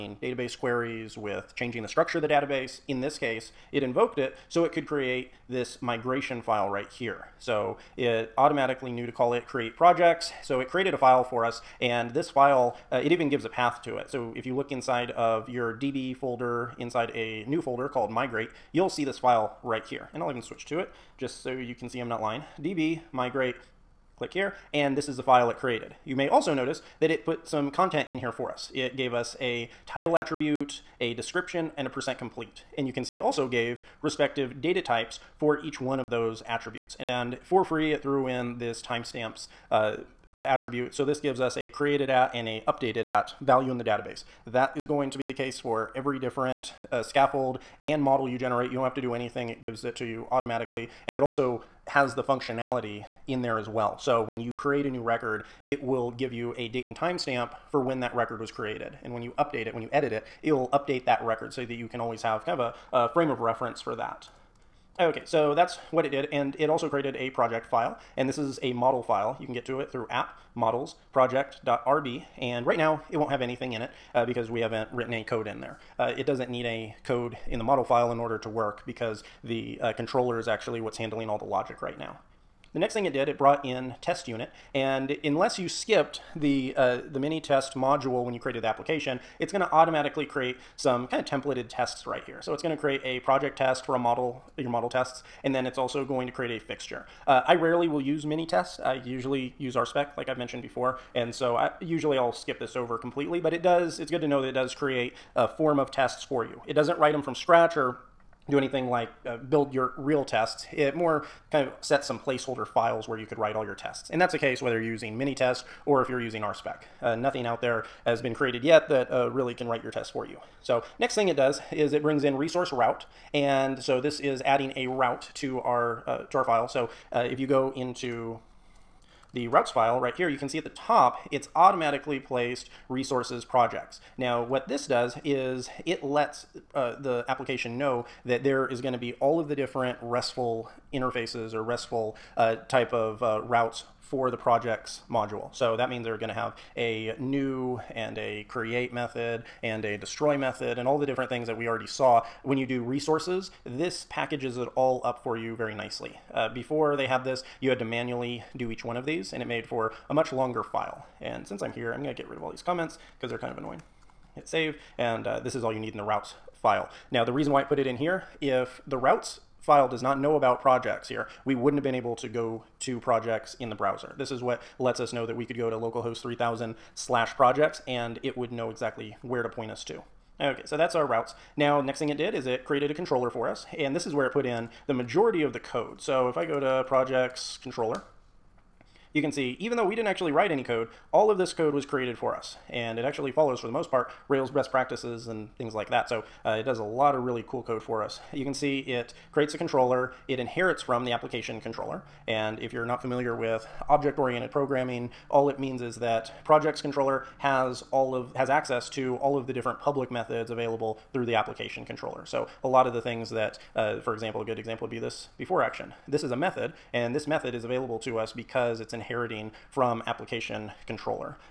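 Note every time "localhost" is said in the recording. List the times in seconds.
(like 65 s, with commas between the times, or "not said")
175 s.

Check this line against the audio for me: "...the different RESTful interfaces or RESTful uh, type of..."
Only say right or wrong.
right.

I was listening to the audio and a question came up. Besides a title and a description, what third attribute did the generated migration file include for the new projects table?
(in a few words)
percent complete.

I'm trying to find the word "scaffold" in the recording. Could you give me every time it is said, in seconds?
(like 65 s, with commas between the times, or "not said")
47 s.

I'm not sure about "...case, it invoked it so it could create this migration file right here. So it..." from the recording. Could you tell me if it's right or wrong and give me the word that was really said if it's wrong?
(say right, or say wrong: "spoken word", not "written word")
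right.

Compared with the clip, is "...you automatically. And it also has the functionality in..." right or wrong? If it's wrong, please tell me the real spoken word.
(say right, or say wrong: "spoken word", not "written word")
right.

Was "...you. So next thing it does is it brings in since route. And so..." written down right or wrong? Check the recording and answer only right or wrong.
wrong.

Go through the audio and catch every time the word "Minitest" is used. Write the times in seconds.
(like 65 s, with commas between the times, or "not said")
87 s, 98 s, 115 s.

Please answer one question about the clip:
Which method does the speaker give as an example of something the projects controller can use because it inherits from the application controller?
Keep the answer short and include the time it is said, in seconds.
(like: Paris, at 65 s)
before action, at 215 s.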